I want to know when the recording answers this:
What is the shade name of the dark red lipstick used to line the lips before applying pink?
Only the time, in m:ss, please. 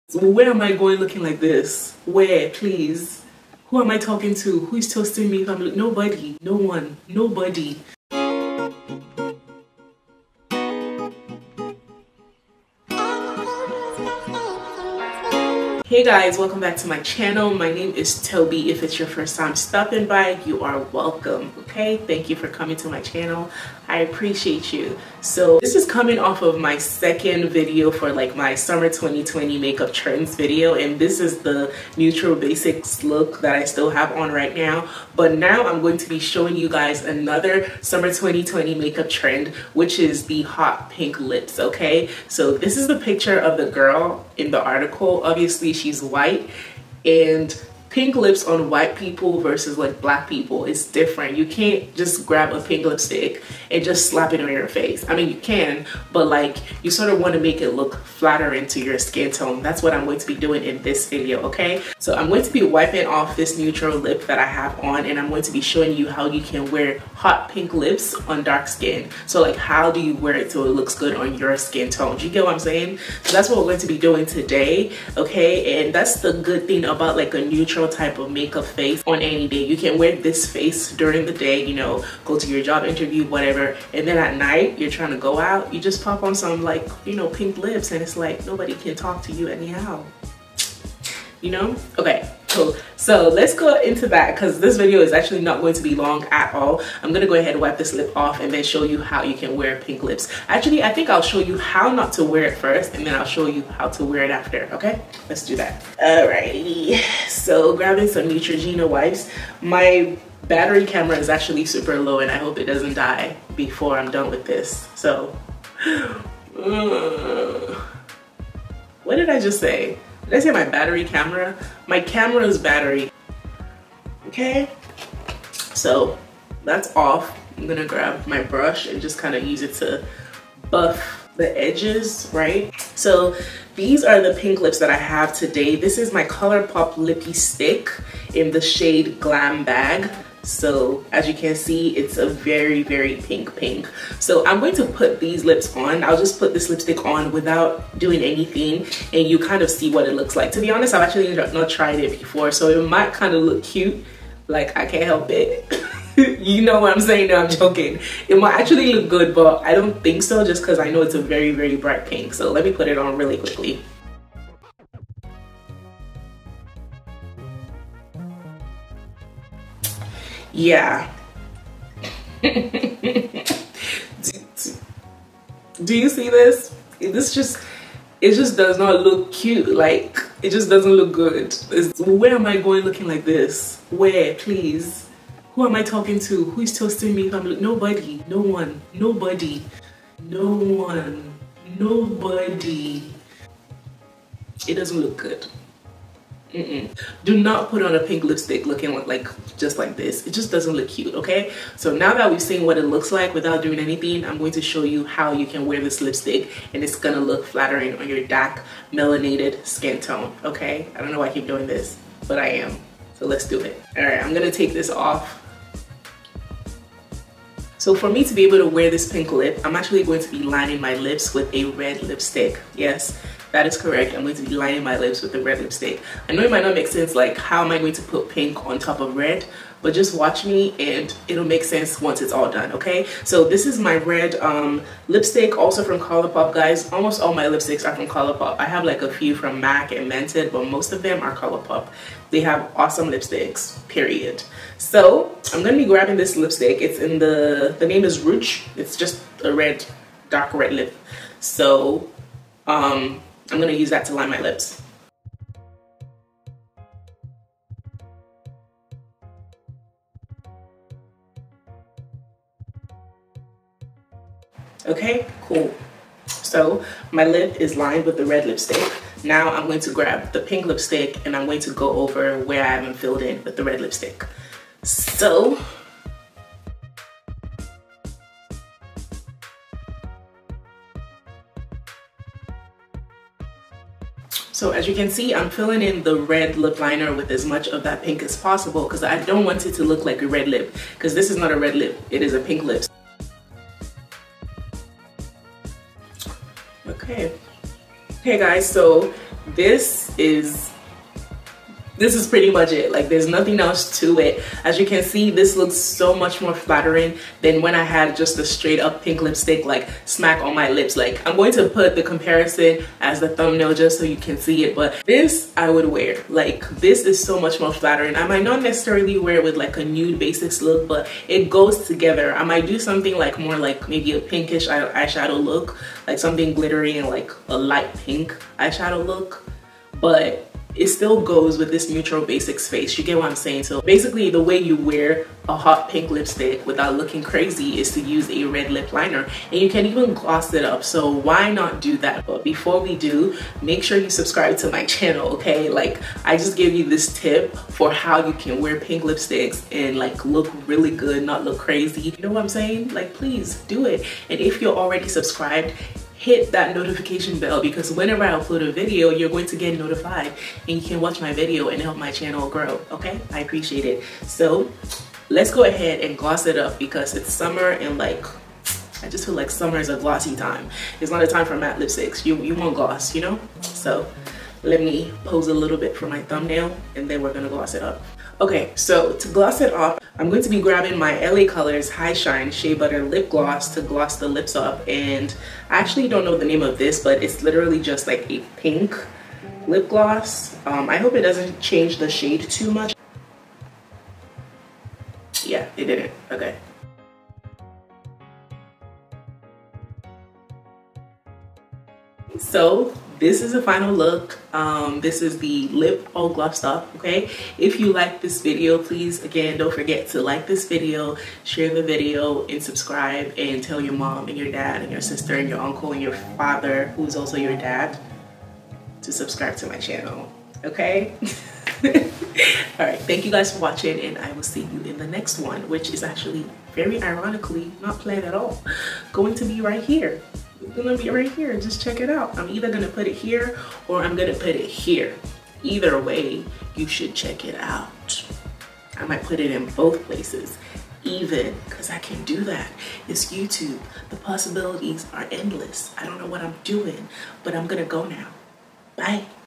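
4:08.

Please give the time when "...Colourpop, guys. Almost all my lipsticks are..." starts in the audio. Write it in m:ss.
3:55.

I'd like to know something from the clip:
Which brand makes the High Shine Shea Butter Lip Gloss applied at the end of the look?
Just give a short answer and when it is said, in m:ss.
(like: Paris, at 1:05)
LA Colors, at 6:21.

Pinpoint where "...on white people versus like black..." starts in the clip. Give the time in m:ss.
0:48.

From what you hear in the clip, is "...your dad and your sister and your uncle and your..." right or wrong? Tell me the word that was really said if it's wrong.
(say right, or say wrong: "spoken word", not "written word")
right.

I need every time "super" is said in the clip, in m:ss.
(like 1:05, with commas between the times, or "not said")
1:51.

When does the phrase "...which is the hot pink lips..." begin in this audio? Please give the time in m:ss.
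0:39.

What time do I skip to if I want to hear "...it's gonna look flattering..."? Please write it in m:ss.
3:26.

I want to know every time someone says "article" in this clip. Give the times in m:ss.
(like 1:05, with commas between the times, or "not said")
0:44.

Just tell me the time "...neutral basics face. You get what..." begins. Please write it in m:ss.
5:31.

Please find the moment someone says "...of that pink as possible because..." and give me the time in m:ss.
4:47.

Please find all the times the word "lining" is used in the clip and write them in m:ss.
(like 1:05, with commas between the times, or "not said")
3:40, 3:44.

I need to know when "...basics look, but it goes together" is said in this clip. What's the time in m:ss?
5:20.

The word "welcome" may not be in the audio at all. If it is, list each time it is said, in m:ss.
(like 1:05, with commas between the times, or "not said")
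0:16, 0:20.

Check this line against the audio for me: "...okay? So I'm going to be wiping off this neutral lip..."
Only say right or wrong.
right.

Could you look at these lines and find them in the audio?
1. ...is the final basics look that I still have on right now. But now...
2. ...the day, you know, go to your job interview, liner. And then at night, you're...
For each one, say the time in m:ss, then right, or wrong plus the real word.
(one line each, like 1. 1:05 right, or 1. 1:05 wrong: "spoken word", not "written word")
1. 0:31 wrong: "neutral", not "final"
2. 1:21 wrong: "whatever", not "liner".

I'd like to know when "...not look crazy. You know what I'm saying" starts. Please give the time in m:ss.
5:51.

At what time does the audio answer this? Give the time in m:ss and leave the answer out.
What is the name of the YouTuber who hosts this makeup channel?
0:18.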